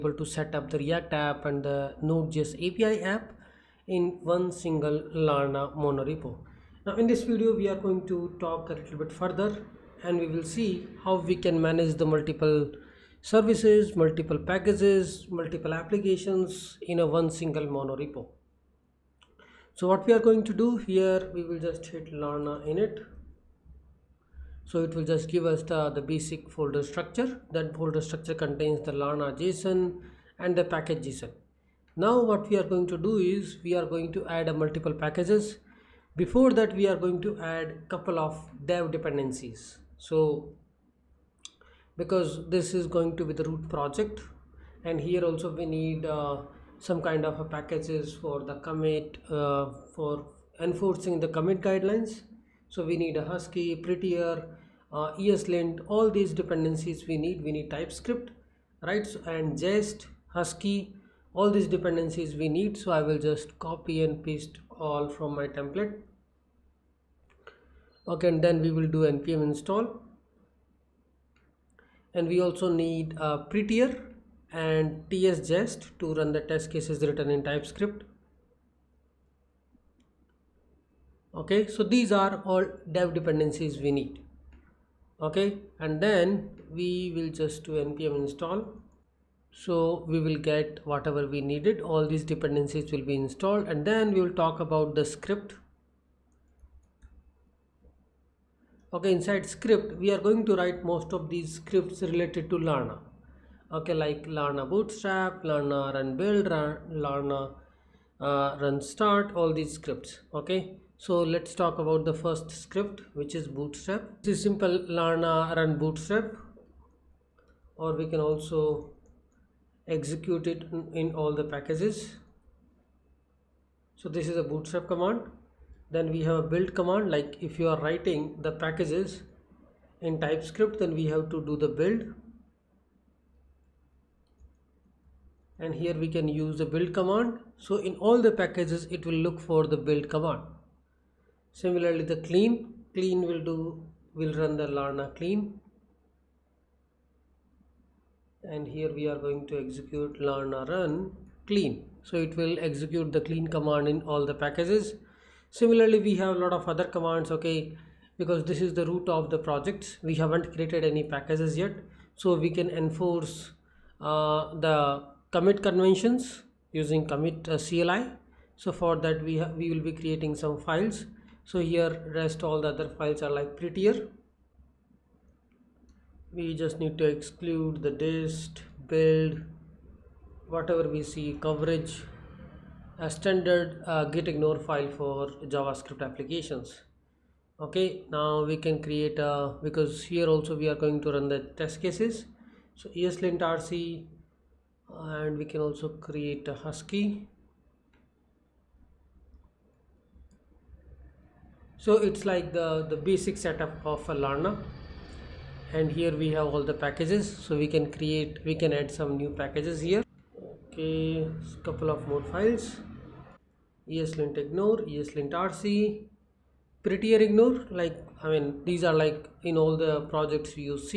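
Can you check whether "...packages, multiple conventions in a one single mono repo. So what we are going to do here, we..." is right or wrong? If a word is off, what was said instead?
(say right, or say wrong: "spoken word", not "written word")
wrong: "applications", not "conventions".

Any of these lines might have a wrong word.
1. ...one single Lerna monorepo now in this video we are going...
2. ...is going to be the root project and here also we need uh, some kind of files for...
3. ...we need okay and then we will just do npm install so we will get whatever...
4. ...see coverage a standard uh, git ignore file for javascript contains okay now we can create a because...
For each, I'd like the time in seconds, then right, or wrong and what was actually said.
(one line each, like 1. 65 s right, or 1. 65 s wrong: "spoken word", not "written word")
1. 4 s right
2. 42 s wrong: "packages", not "files"
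3. 83 s right
4. 181 s wrong: "applications", not "contains".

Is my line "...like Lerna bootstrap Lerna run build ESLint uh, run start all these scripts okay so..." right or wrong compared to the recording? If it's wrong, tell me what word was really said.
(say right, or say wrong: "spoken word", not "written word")
wrong: "Lerna", not "ESLint".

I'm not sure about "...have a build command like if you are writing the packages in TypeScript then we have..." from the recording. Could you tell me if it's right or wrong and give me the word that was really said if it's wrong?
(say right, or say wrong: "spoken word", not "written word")
right.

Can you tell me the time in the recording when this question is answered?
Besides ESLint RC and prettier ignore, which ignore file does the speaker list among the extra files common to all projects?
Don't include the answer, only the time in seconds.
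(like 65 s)
213 s.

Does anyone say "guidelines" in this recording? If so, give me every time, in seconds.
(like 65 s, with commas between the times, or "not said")
51 s.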